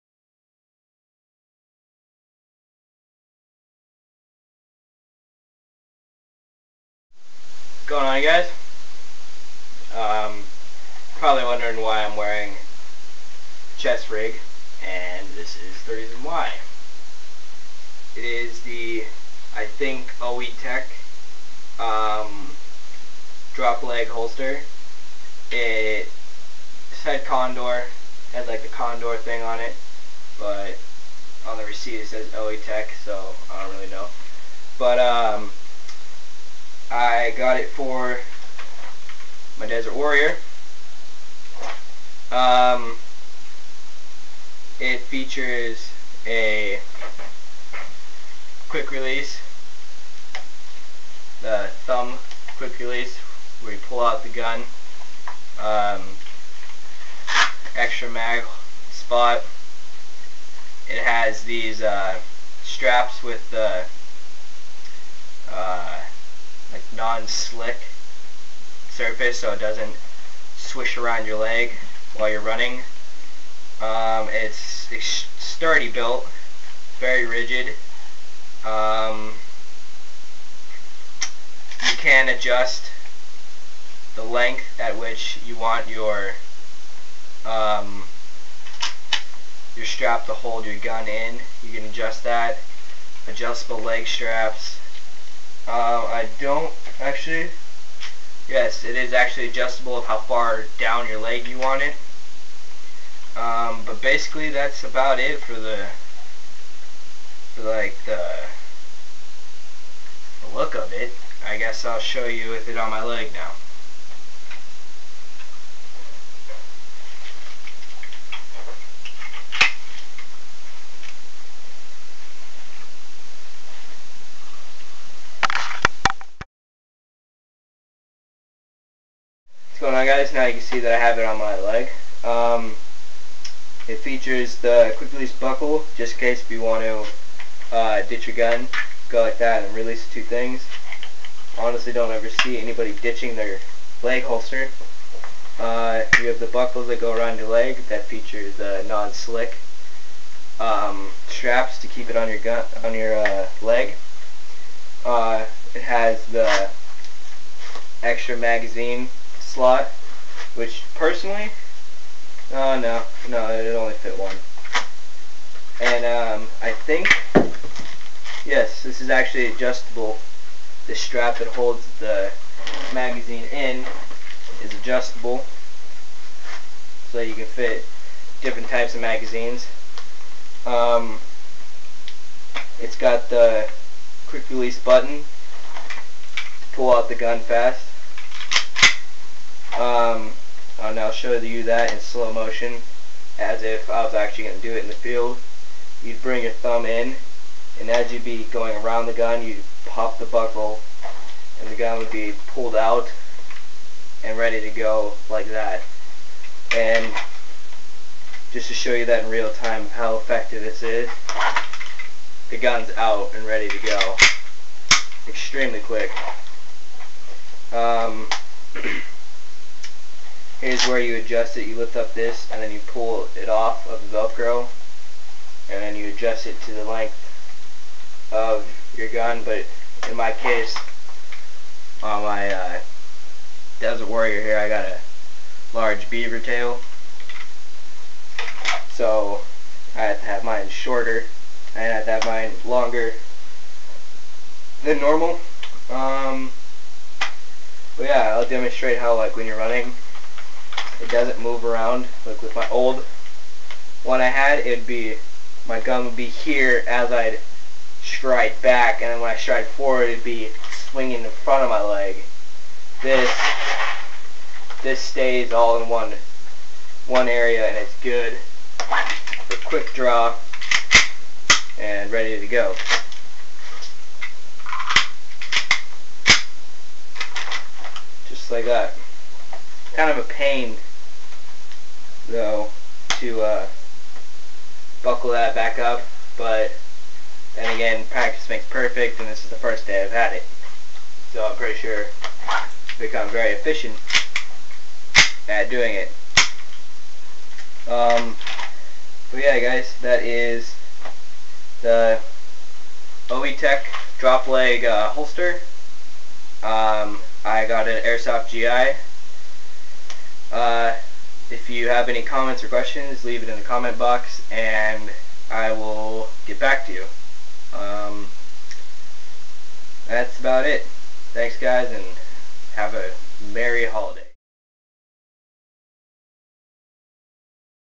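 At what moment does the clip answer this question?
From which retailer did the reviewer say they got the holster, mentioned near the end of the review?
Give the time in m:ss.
5:08.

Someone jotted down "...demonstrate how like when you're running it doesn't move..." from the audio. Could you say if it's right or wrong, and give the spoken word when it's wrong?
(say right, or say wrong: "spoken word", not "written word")
right.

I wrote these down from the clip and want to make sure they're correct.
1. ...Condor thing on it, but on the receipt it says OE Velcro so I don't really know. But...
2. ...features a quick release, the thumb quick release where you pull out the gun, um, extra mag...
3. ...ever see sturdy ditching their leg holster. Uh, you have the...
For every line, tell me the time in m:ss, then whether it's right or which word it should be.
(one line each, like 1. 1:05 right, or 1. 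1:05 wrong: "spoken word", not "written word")
1. 0:28 wrong: "Tech", not "Velcro"
2. 0:44 right
3. 2:22 wrong: "anybody", not "sturdy".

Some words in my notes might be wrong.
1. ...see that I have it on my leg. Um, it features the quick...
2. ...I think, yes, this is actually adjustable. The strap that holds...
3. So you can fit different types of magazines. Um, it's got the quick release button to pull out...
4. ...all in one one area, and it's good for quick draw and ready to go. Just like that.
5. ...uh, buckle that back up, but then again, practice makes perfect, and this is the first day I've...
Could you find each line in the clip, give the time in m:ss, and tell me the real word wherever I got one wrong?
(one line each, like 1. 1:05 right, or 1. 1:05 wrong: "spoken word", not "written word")
1. 2:10 right
2. 2:46 right
3. 2:57 right
4. 4:25 right
5. 4:43 right.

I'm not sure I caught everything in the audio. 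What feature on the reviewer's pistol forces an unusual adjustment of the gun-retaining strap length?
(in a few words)
large beaver tail.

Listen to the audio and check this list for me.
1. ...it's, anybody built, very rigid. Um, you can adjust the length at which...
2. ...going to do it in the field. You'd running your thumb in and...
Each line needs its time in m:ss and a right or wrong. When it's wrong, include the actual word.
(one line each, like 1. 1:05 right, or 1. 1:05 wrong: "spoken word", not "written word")
1. 1:14 wrong: "sturdy", not "anybody"
2. 3:14 wrong: "bring", not "running".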